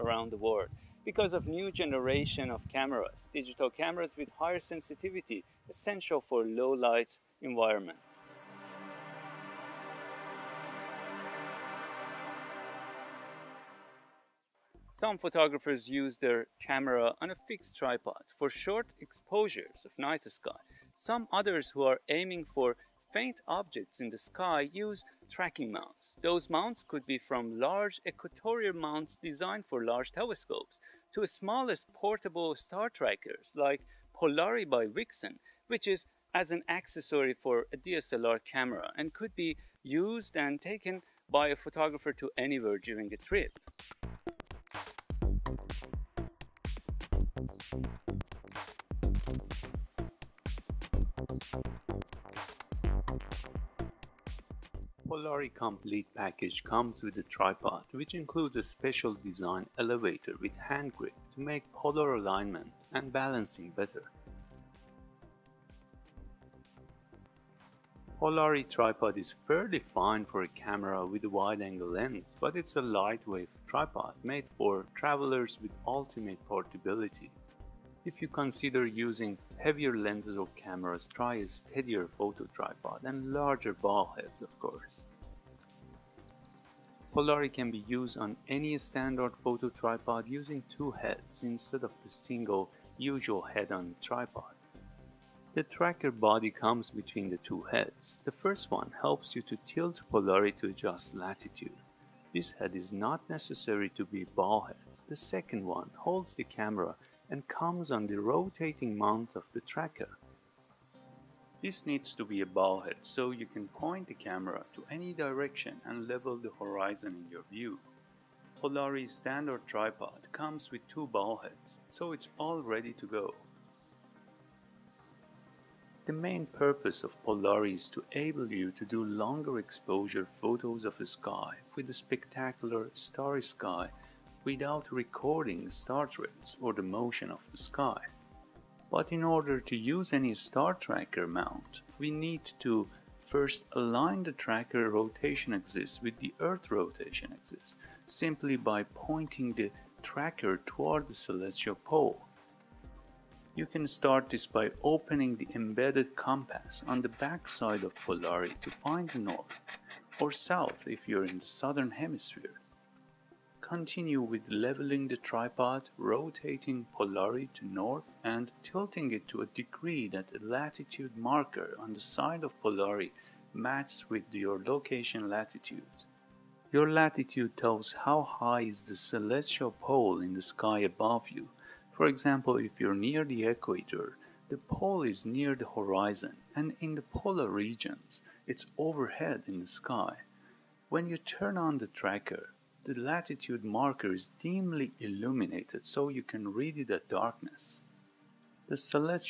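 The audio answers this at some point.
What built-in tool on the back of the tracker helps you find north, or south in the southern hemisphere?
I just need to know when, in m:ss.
2:36.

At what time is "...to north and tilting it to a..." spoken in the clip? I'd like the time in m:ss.
2:47.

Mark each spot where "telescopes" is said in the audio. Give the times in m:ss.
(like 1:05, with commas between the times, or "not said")
0:30.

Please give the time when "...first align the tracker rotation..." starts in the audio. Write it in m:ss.
2:23.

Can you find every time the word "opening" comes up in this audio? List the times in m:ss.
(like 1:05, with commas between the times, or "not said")
2:34.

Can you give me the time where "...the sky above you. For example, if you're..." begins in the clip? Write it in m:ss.
3:00.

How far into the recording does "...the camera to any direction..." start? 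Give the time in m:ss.
1:54.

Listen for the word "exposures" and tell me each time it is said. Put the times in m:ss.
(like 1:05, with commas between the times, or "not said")
0:19, 2:09.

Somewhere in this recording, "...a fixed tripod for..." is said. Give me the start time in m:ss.
0:17.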